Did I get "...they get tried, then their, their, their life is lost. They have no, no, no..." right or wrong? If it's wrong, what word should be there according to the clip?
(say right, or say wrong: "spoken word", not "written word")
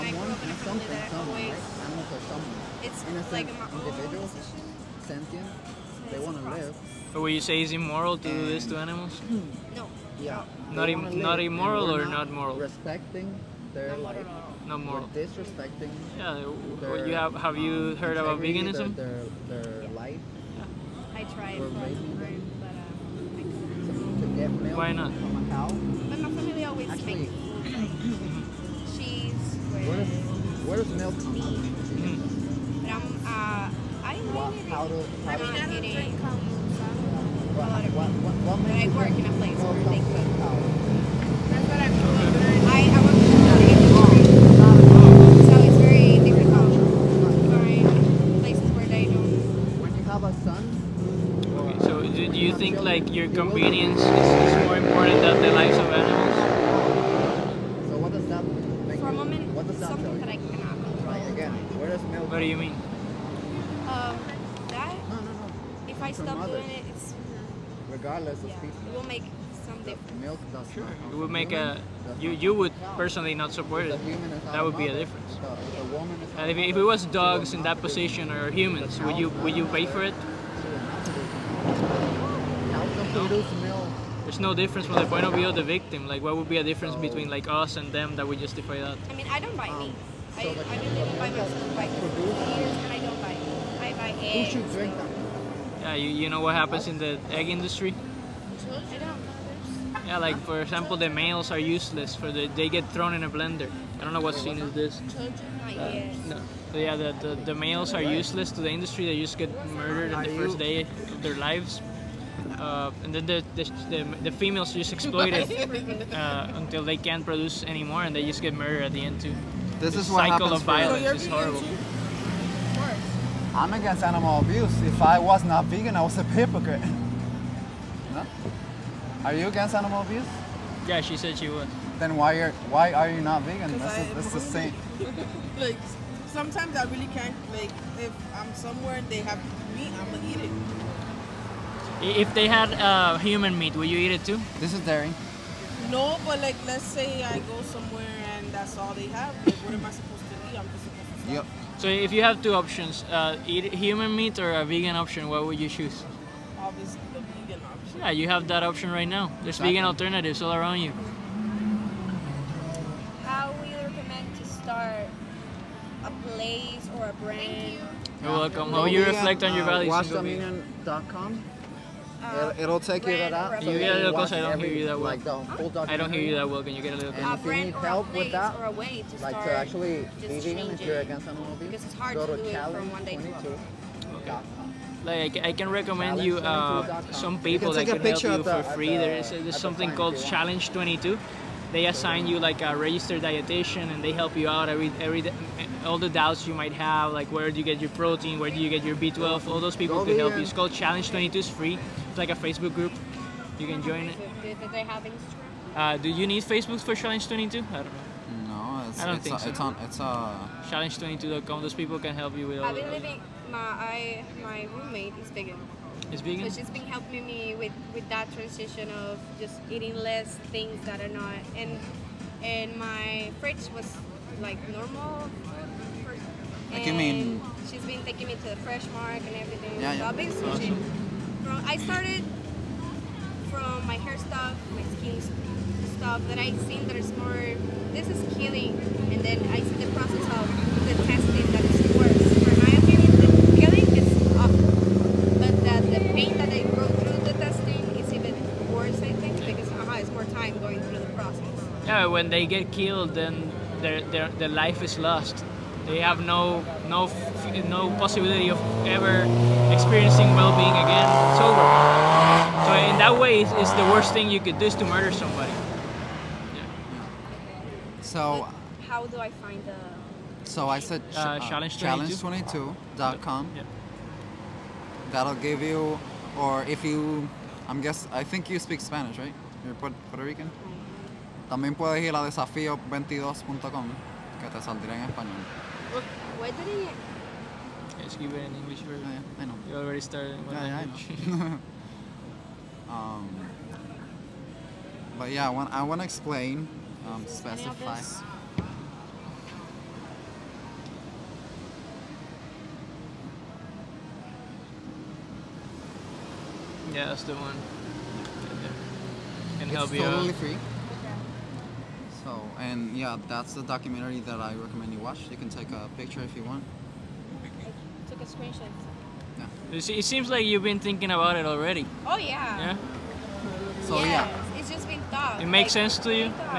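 wrong: "killed", not "tried".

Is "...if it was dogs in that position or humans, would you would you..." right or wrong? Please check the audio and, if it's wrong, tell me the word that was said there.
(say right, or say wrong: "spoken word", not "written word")
right.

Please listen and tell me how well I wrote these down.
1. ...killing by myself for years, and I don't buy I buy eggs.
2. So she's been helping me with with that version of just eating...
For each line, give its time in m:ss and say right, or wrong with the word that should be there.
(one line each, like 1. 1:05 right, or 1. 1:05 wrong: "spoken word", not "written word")
1. 1:30 wrong: "living", not "killing"
2. 3:36 wrong: "transition", not "version".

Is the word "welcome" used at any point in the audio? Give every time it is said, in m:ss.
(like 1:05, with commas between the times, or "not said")
2:48.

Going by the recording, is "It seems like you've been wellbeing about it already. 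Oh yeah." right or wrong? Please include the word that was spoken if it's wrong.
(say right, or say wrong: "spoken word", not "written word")
wrong: "thinking", not "wellbeing".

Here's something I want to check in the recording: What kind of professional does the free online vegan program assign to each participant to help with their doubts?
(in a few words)
registered dietitian.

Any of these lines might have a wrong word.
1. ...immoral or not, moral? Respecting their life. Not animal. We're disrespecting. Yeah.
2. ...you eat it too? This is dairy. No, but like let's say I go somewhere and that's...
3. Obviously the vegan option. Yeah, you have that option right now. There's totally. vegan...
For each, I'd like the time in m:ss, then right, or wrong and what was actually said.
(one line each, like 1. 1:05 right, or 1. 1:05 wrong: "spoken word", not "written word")
1. 0:11 wrong: "moral", not "animal"
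2. 2:23 right
3. 2:36 wrong: "exactly", not "totally".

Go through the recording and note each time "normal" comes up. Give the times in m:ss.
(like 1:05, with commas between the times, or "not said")
3:44.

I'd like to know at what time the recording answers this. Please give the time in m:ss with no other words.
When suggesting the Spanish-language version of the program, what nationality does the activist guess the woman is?
4:39.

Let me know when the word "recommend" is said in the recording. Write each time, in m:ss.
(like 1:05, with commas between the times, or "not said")
2:43, 3:05, 5:14.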